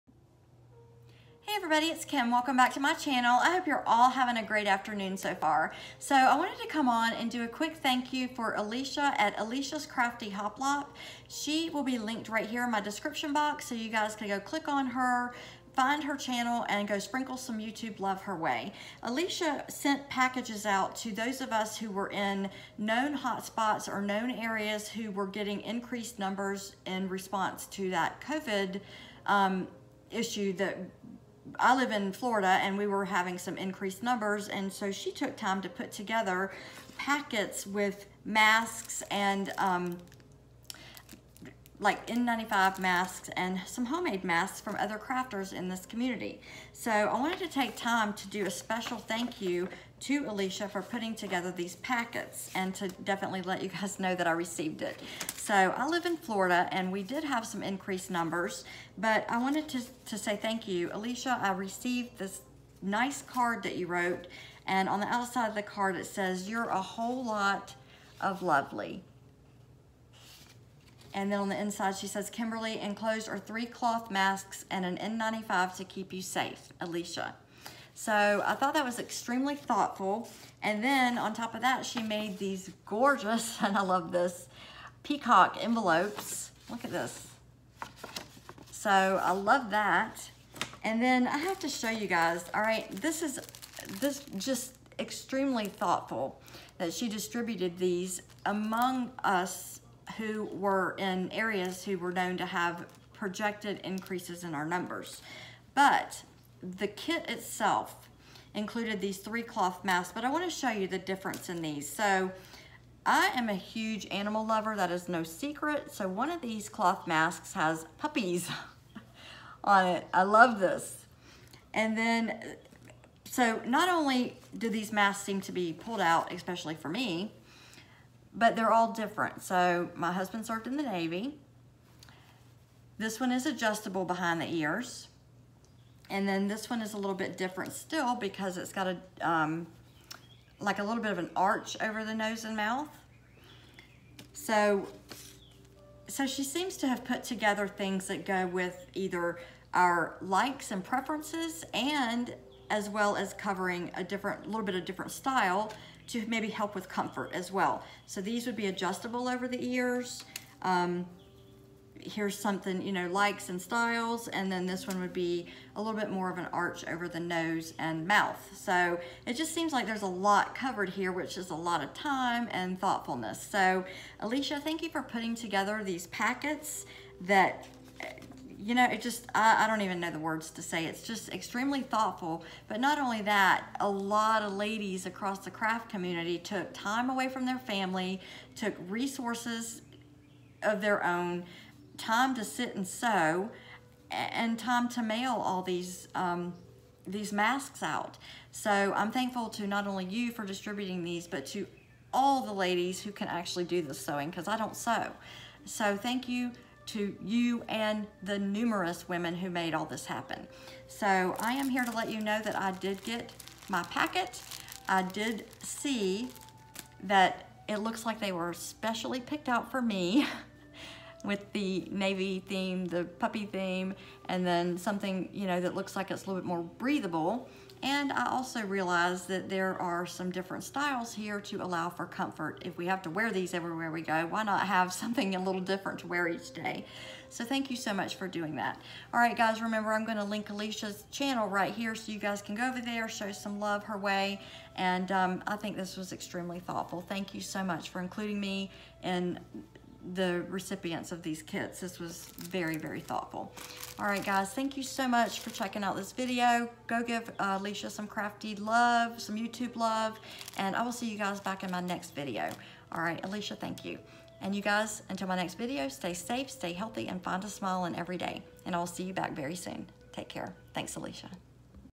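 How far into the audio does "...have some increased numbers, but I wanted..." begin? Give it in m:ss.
0:57.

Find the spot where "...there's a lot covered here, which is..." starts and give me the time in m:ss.
2:49.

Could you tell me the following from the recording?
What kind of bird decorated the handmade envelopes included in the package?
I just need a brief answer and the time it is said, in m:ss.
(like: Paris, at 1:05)
Peacock, at 1:25.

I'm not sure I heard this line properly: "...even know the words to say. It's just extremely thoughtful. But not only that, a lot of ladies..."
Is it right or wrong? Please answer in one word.
right.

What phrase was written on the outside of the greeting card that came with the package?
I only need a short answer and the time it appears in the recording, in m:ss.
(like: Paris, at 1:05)
You're a whole lot of lovely, at 1:06.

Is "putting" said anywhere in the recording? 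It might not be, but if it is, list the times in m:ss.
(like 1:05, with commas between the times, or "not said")
0:50, 2:55.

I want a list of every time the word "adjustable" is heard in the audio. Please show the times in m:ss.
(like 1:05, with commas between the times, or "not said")
2:13, 2:38.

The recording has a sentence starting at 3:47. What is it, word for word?
And I also realized that there are some different styles here to allow for comfort.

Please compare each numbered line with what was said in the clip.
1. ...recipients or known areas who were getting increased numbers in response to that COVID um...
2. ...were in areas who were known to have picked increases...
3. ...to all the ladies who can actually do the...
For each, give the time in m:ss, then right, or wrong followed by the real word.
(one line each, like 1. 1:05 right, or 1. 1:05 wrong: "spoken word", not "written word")
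1. 0:23 wrong: "hotspots", not "recipients"
2. 1:40 wrong: "projected", not "picked"
3. 3:21 right.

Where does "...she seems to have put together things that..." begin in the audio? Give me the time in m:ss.
2:26.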